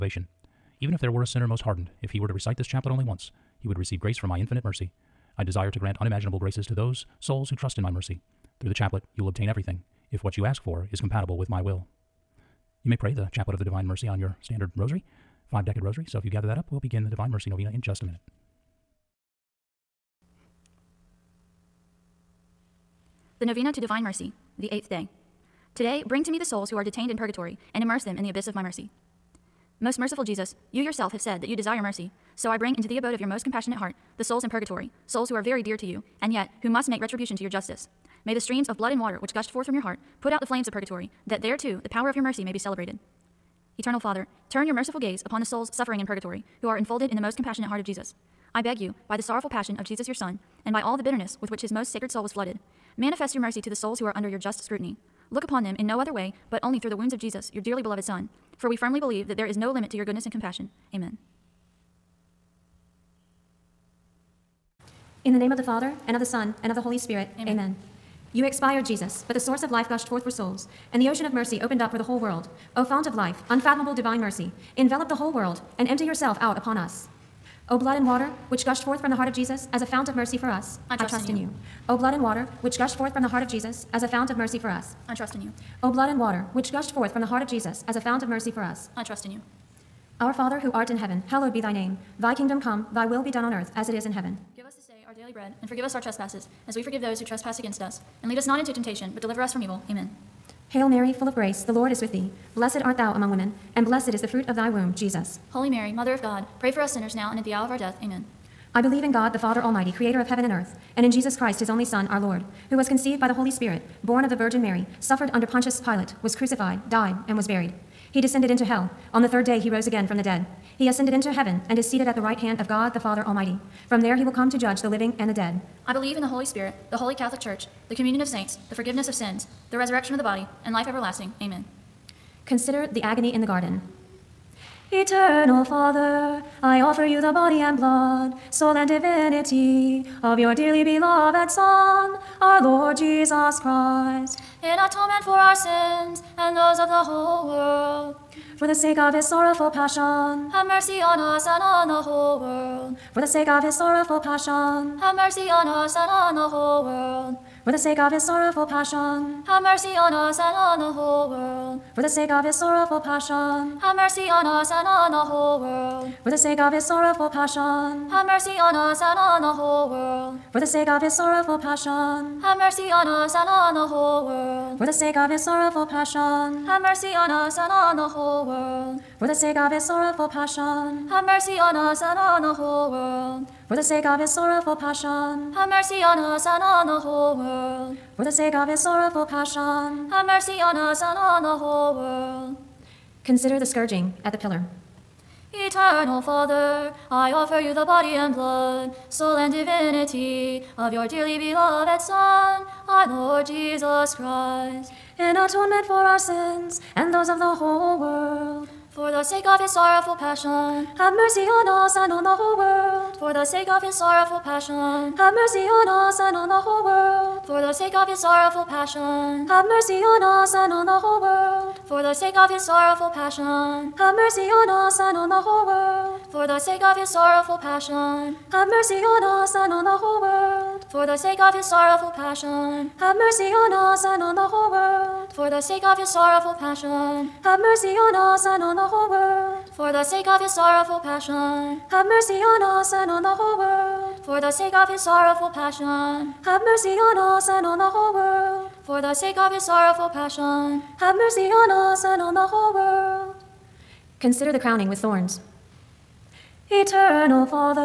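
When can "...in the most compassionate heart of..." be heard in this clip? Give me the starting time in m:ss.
0:47.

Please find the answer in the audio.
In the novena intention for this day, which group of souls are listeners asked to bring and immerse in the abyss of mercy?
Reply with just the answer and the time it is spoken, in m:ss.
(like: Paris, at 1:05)
Souls in purgatory, at 0:26.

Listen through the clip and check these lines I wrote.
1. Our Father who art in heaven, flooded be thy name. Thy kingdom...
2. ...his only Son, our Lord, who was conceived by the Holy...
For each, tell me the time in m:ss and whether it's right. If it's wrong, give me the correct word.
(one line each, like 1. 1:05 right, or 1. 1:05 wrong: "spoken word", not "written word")
1. 1:30 wrong: "hallowed", not "flooded"
2. 1:51 right.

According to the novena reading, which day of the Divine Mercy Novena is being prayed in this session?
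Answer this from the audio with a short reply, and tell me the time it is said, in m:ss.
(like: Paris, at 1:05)
Eighth day, at 0:24.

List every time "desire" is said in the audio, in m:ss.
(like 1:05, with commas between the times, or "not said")
0:05, 0:31.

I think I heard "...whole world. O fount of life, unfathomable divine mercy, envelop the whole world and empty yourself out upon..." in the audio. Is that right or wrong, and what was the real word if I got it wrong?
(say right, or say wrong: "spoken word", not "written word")
right.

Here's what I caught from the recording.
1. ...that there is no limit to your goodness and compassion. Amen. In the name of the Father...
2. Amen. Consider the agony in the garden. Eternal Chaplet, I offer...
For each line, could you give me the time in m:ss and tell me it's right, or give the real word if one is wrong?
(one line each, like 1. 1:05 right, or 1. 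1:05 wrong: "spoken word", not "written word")
1. 0:59 right
2. 2:11 wrong: "Father", not "Chaplet".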